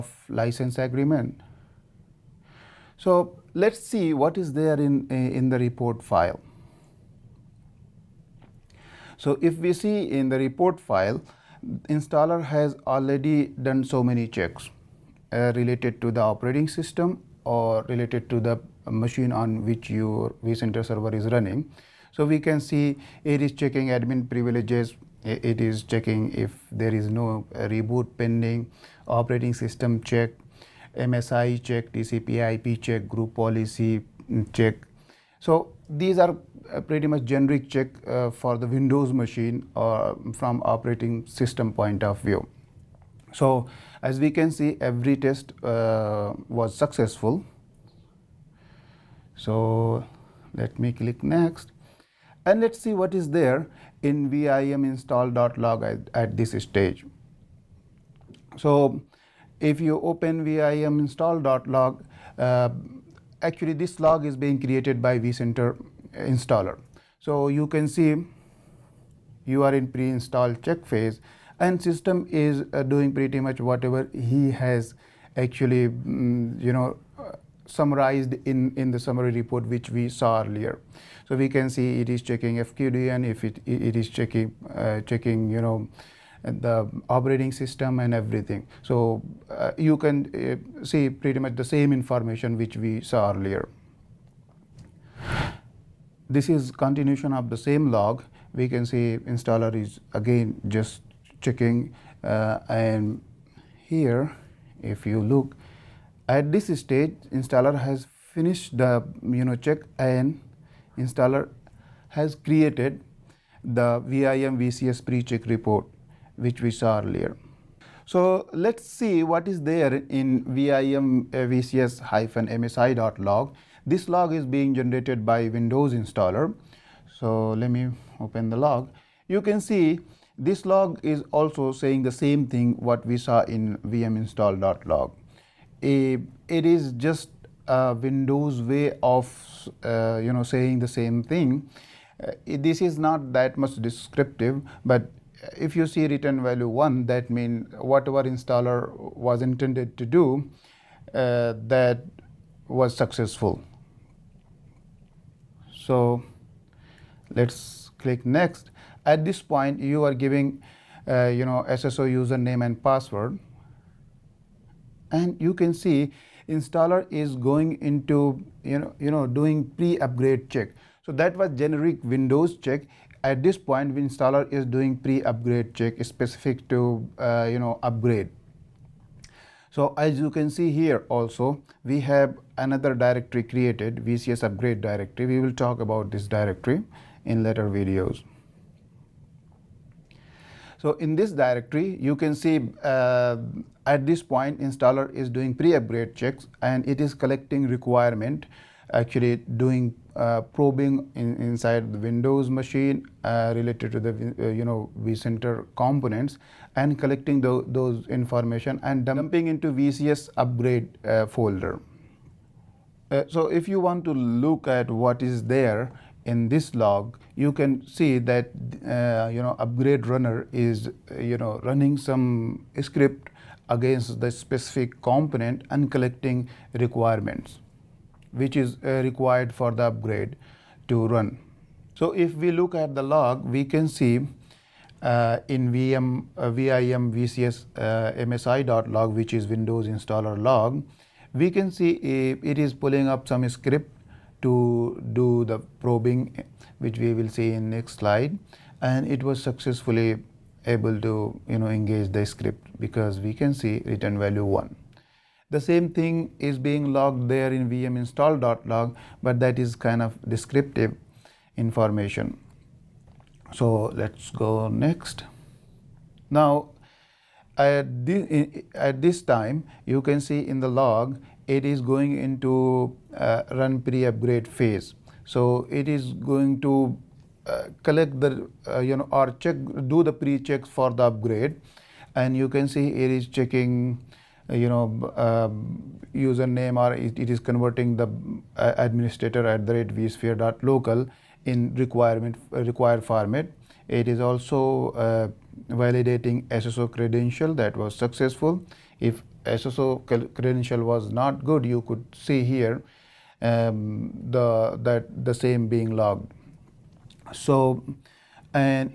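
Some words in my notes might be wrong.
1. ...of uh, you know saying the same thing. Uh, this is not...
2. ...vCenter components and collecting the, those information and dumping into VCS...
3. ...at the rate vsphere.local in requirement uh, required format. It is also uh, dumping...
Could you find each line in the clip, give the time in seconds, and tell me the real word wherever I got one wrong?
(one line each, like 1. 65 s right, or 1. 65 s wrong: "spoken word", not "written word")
1. 139 s right
2. 205 s right
3. 289 s wrong: "validating", not "dumping".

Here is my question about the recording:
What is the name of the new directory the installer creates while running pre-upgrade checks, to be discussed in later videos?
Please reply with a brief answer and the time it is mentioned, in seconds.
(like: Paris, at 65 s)
vcs upgrade directory, at 184 s.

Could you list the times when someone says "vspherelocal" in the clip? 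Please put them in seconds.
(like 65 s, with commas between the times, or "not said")
289 s.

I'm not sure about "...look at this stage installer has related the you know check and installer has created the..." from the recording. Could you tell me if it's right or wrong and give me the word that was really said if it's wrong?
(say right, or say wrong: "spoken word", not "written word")
wrong: "finished", not "related".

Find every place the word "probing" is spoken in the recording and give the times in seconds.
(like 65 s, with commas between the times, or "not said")
200 s, 245 s.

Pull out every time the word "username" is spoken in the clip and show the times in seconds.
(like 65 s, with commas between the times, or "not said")
162 s, 286 s.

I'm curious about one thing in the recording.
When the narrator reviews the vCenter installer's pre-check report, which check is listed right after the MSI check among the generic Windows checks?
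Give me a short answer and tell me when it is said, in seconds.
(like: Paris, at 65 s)
TCP IP check, at 31 s.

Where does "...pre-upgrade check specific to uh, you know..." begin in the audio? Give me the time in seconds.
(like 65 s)
174 s.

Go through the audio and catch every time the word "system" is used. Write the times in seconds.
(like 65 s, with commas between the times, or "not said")
16 s, 29 s, 41 s, 71 s, 87 s.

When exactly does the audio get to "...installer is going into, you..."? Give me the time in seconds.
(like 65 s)
166 s.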